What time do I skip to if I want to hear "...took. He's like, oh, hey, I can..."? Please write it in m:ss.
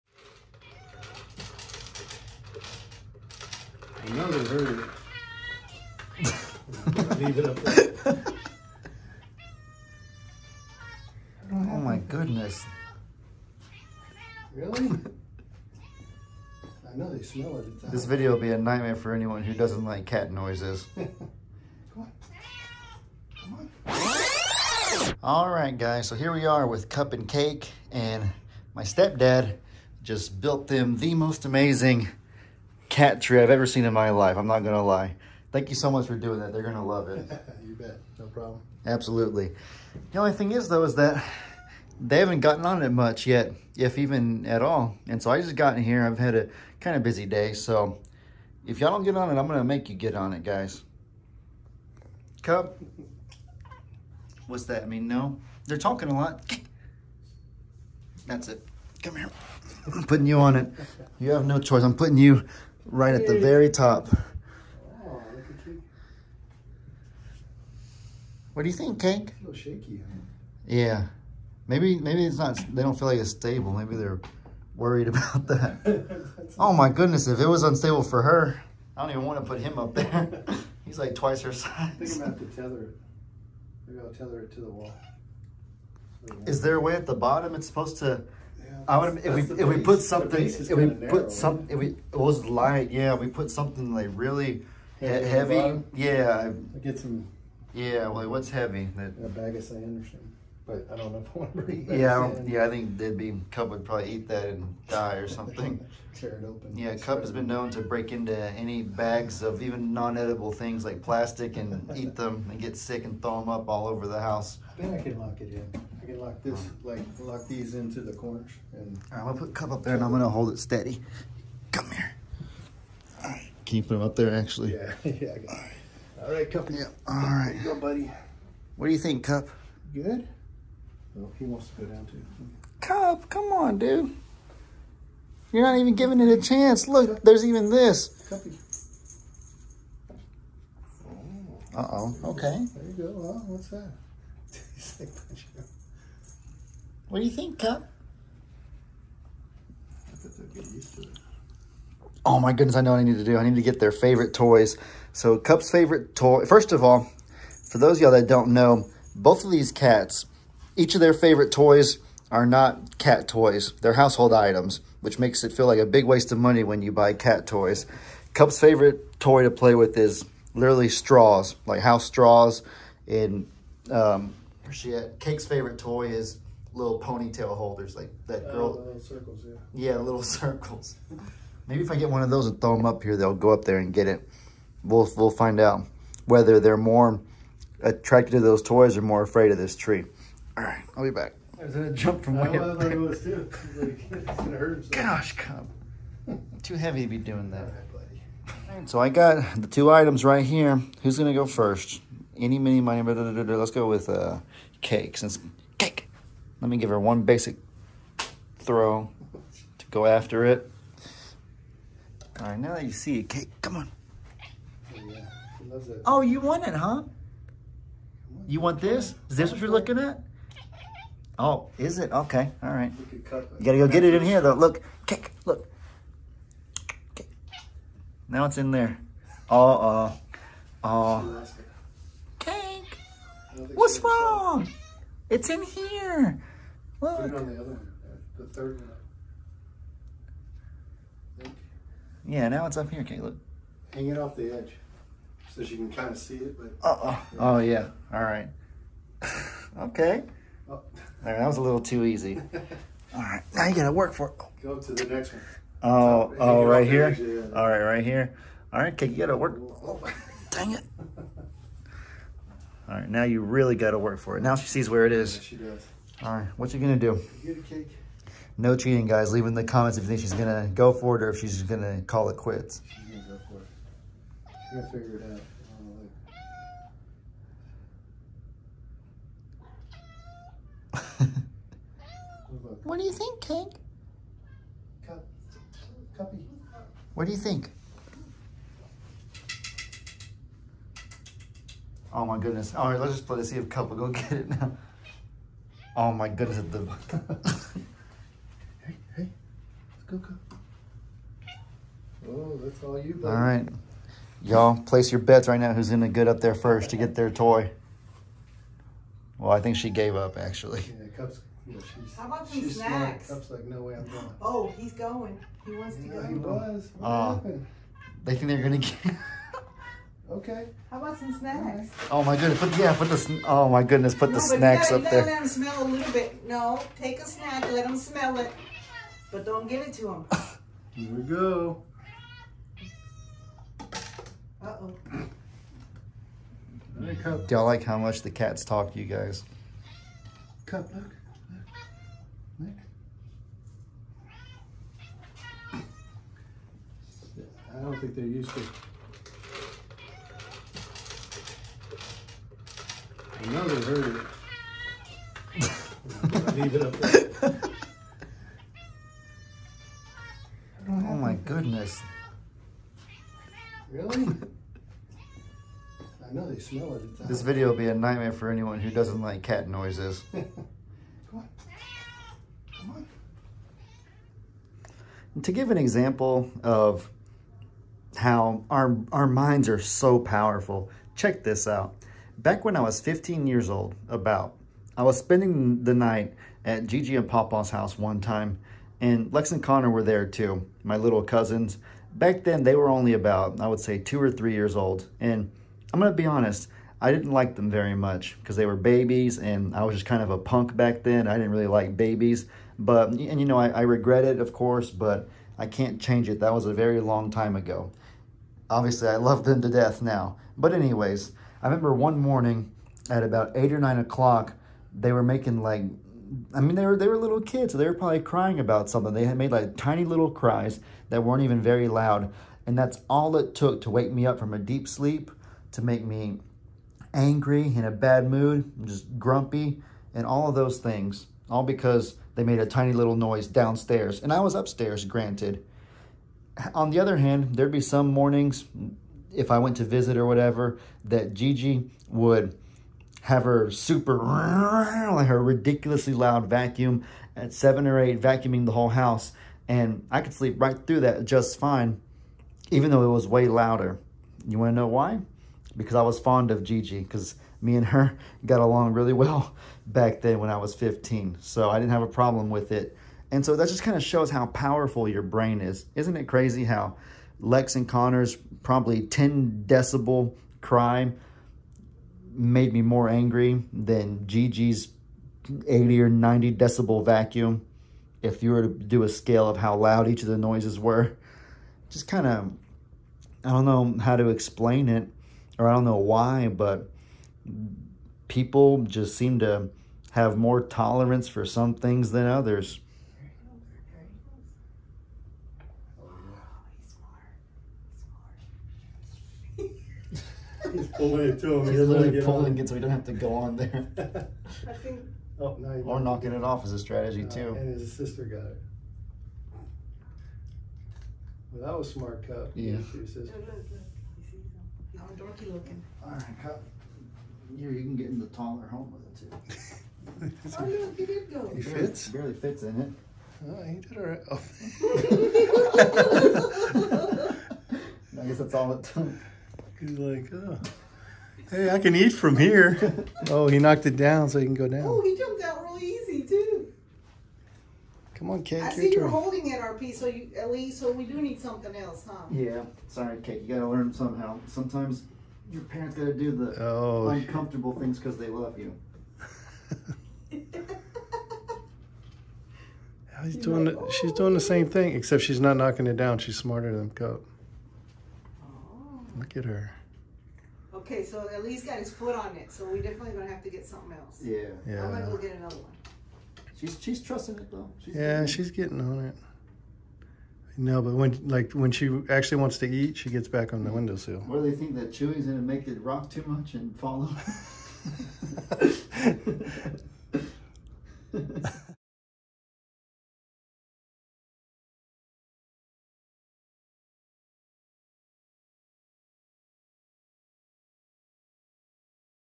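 8:48.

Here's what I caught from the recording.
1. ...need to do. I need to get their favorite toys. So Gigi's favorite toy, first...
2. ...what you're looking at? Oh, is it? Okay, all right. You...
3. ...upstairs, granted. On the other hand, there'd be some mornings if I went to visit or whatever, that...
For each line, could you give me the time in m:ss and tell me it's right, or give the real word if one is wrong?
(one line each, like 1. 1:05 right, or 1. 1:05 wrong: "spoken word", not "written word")
1. 2:33 wrong: "Cup", not "Gigi"
2. 3:39 right
3. 7:14 right.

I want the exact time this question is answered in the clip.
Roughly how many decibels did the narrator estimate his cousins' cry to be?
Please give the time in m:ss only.
7:49.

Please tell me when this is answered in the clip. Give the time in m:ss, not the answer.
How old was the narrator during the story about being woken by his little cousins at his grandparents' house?
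6:22.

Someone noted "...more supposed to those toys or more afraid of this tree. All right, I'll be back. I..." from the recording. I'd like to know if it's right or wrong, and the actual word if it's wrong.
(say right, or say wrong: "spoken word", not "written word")
wrong: "attracted", not "supposed".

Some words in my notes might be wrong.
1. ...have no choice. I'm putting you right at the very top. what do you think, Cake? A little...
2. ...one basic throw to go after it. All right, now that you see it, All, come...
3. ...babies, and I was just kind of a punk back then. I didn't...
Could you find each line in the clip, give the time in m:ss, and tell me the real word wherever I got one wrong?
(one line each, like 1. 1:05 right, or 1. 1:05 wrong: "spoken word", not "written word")
1. 1:01 right
2. 3:26 wrong: "Cake", not "All"
3. 6:38 right.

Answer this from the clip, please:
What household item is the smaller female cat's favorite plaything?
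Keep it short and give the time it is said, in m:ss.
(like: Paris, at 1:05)
Ponytail holders, at 2:56.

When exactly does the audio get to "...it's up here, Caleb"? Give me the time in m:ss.
4:02.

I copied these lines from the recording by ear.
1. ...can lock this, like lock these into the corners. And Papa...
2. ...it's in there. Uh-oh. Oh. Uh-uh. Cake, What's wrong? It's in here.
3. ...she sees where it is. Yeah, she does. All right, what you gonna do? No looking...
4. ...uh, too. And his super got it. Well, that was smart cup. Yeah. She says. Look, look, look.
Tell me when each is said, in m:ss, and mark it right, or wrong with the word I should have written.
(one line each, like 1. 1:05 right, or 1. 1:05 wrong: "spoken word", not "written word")
1. 1:56 wrong: "All", not "Papa"
2. 3:48 right
3. 4:24 wrong: "cheating", not "looking"
4. 8:27 wrong: "sister", not "super".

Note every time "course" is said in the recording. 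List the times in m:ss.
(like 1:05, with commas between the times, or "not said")
6:44.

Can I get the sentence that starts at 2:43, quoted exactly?
They're household items, which makes it feel like a big waste of money when you buy cat toys.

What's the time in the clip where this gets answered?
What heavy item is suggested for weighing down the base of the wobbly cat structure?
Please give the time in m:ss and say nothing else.
1:39.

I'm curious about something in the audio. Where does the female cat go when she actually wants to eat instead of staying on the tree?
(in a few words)
The windowsill.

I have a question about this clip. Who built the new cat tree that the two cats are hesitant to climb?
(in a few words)
Stepdad.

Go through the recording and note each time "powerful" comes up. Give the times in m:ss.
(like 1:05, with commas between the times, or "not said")
6:20, 7:44.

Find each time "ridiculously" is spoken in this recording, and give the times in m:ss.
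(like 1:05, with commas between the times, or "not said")
7:25.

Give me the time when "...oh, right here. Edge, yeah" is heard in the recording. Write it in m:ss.
4:16.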